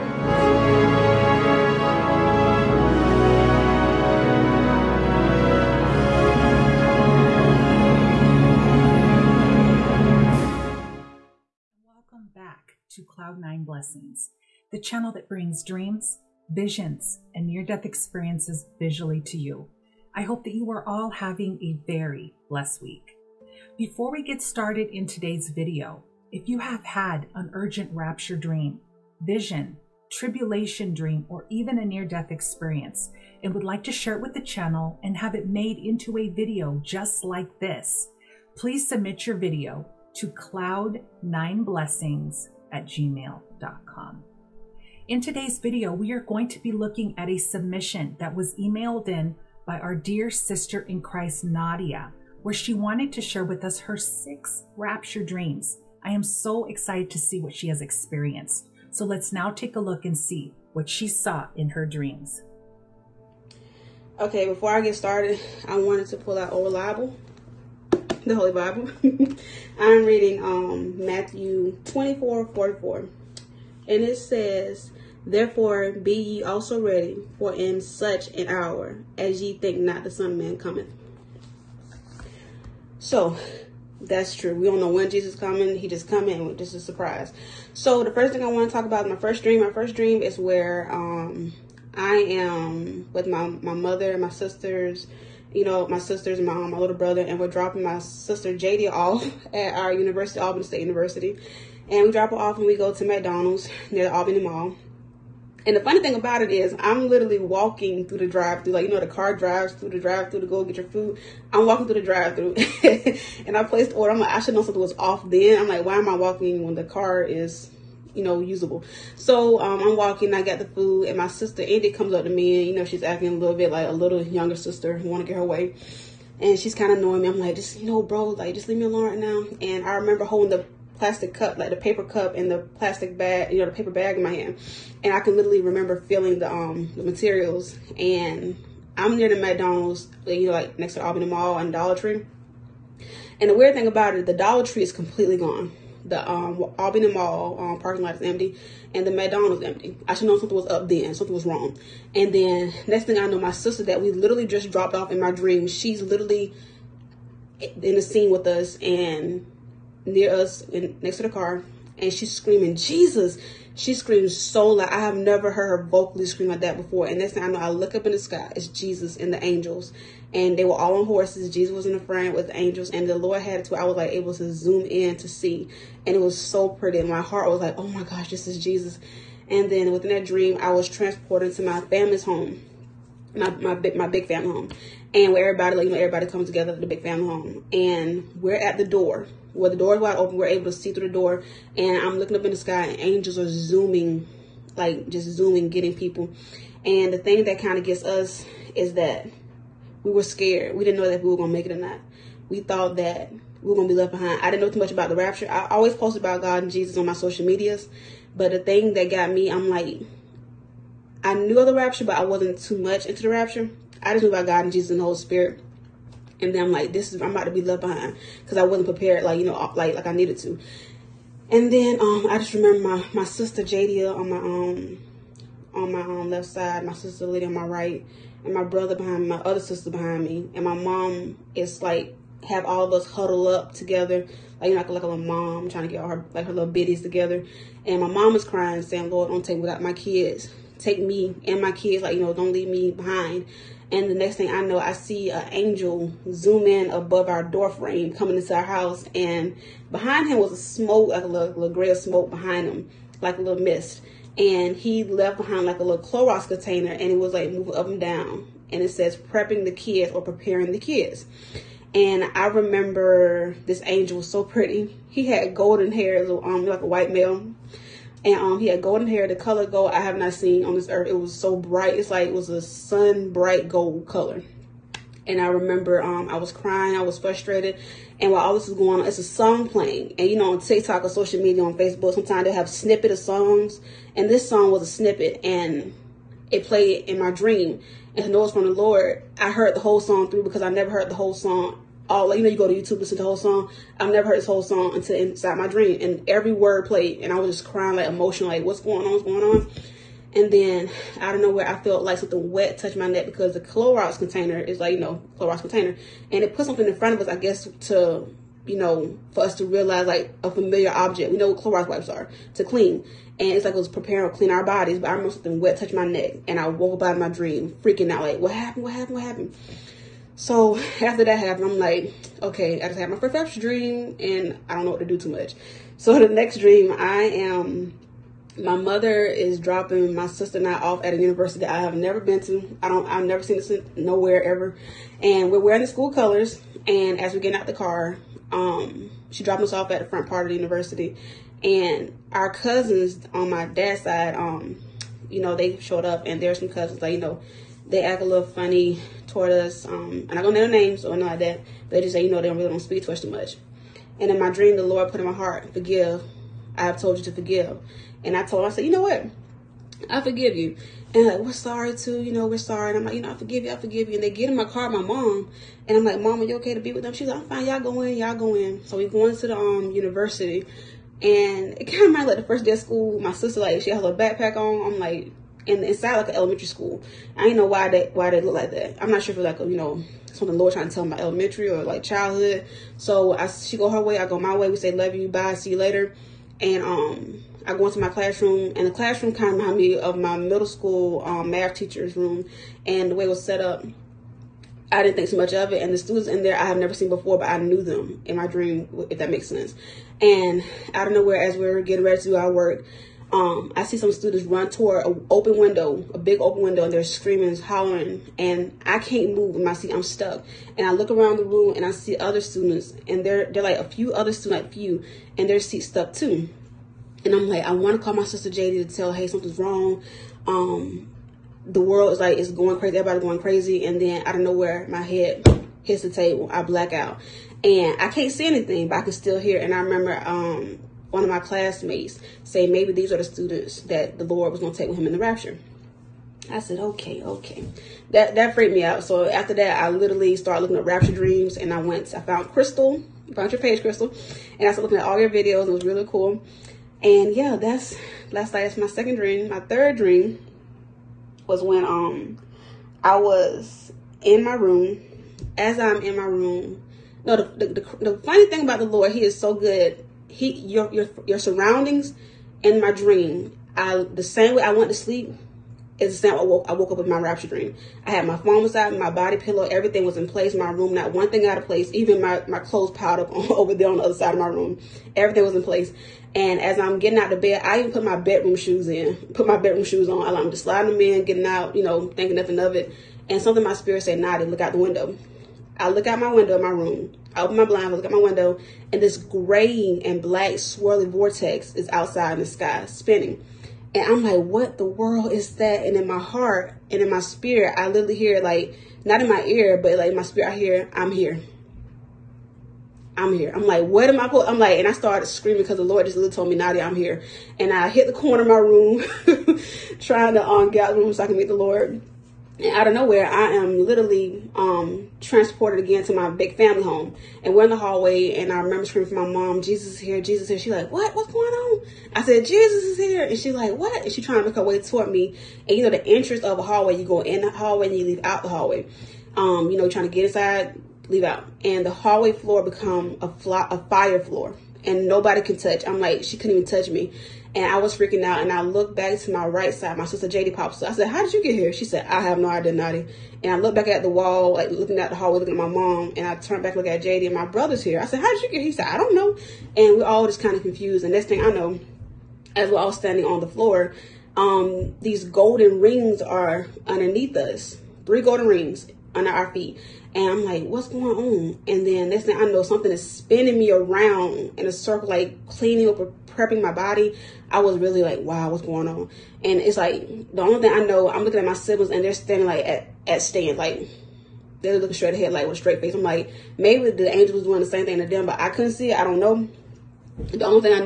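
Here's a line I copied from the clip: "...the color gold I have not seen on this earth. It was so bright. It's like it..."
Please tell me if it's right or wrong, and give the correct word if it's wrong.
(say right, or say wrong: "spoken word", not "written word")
right.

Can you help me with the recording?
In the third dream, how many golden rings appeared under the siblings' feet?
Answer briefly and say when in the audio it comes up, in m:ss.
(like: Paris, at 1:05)
3, at 9:18.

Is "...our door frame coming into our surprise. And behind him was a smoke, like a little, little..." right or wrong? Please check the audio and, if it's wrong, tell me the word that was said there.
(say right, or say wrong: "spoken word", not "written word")
wrong: "house", not "surprise".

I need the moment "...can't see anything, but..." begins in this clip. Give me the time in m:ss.
7:08.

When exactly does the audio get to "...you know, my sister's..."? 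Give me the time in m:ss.
1:35.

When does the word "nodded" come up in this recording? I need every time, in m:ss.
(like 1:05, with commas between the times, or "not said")
8:04.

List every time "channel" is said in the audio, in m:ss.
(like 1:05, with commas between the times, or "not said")
0:14, 0:34.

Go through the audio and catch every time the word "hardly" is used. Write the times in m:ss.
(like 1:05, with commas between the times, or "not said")
not said.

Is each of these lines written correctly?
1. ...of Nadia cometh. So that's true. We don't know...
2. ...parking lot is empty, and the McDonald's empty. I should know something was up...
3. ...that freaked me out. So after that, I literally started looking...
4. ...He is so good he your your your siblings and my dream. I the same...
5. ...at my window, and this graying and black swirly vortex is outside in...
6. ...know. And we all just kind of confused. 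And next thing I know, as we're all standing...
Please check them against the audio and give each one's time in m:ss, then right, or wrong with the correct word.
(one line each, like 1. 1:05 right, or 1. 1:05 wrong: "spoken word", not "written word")
1. 1:20 wrong: "Man", not "Nadia"
2. 2:27 right
3. 7:18 right
4. 7:39 wrong: "surroundings", not "siblings"
5. 8:08 right
6. 9:09 right.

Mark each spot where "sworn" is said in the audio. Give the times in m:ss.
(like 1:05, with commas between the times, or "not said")
not said.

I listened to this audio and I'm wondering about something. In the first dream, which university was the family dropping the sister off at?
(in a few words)
Albany State University.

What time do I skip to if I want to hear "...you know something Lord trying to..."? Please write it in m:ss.
6:19.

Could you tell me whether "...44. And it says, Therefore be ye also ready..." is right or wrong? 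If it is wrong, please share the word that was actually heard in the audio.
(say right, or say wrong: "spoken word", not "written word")
right.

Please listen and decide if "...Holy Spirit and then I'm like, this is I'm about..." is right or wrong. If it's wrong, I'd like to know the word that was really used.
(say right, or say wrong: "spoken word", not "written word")
right.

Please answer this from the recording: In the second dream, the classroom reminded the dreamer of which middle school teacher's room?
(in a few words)
Math teacher.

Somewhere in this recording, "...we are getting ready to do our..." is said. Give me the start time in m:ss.
6:41.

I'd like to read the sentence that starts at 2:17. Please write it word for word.
And I'm near the McDonald's, you know, like next to Albany Mall and Dollar Tree.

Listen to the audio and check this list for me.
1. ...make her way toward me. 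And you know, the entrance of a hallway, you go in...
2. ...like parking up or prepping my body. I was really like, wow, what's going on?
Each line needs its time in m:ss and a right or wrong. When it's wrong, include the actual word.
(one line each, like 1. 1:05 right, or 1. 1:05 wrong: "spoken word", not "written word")
1. 8:44 right
2. 9:25 wrong: "cleaning", not "parking".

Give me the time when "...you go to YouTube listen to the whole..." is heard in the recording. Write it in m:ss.
4:52.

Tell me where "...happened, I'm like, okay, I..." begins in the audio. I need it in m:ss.
5:21.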